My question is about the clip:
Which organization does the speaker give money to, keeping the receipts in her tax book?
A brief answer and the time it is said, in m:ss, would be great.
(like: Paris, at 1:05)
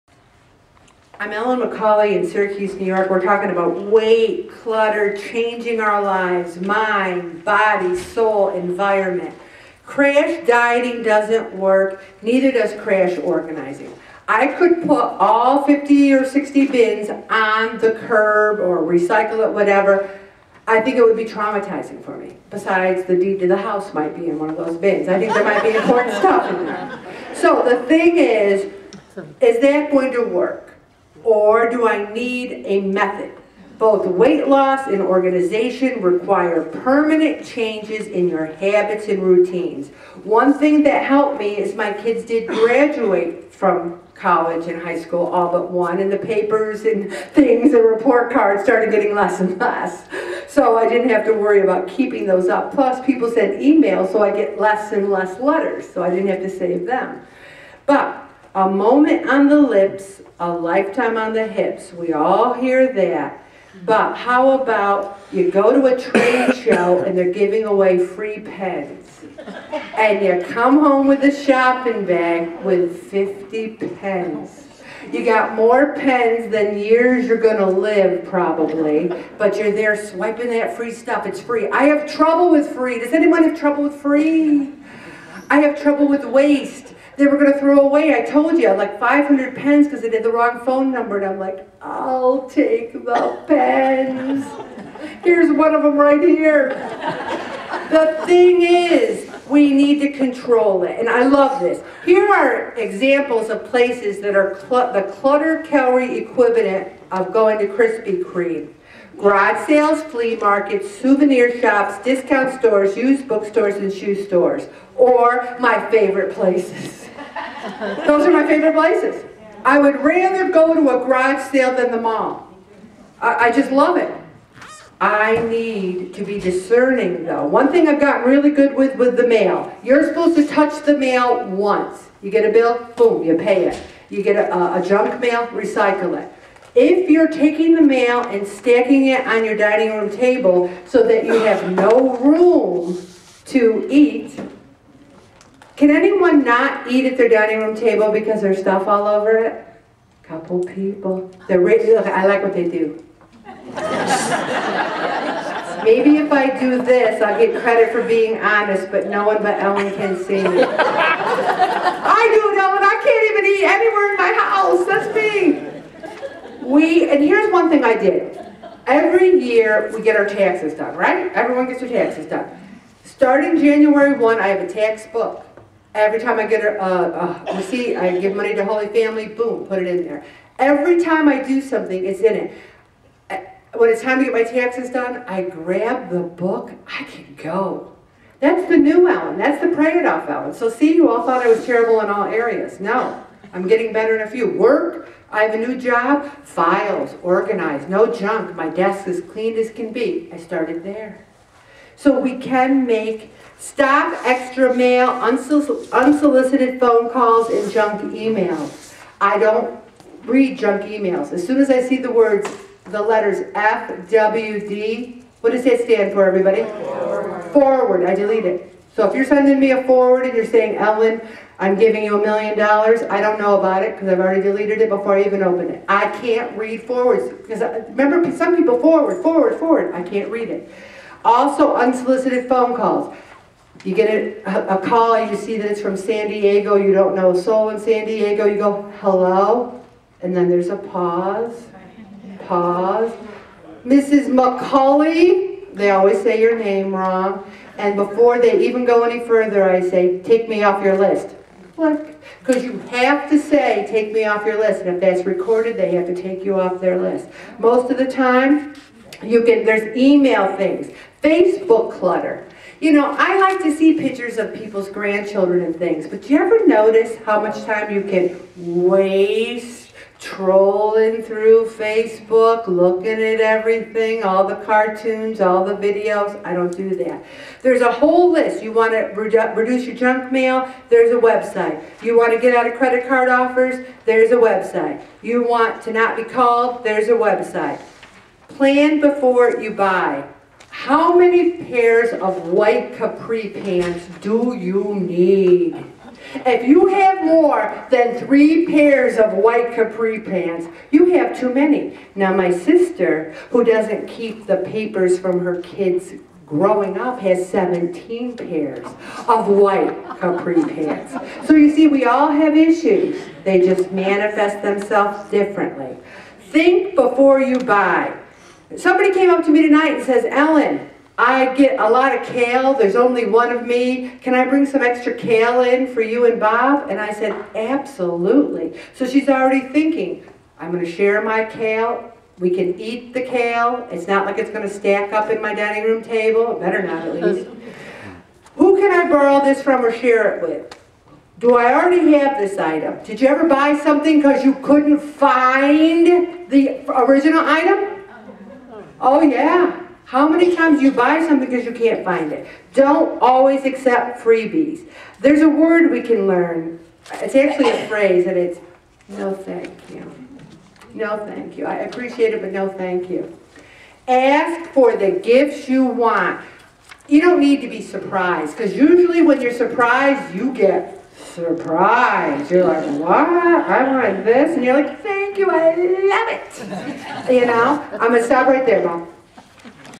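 Holy Family, at 2:58.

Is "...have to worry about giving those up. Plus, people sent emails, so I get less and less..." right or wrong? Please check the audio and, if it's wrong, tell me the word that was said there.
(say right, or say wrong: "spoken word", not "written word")
wrong: "keeping", not "giving".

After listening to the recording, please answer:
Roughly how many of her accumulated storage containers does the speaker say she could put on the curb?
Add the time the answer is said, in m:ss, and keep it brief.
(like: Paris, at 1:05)
50 or 60, at 0:15.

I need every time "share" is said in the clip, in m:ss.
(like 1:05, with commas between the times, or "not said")
5:30, 5:39.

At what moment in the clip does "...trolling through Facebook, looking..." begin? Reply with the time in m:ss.
4:30.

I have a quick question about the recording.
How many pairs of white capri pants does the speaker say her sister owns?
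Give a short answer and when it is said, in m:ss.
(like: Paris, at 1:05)
17, at 5:07.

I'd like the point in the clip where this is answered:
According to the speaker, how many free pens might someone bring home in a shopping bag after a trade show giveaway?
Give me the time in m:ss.
1:13.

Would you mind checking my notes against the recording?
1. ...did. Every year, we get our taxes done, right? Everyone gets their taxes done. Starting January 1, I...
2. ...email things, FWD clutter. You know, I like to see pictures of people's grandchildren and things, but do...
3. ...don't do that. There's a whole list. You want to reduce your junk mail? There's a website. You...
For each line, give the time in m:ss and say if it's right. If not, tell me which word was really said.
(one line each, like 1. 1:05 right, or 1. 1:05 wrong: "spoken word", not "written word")
1. 2:47 right
2. 4:19 wrong: "Facebook", not "FWD"
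3. 4:36 right.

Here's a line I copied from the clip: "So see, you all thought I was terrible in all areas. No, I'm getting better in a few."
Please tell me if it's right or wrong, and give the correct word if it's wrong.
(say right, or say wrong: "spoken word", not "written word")
right.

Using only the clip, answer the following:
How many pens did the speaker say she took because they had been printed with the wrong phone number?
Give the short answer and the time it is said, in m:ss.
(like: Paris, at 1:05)
500, at 1:28.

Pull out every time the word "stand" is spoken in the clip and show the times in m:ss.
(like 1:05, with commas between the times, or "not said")
3:35.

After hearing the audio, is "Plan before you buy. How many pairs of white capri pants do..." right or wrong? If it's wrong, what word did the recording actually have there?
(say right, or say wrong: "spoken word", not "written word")
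right.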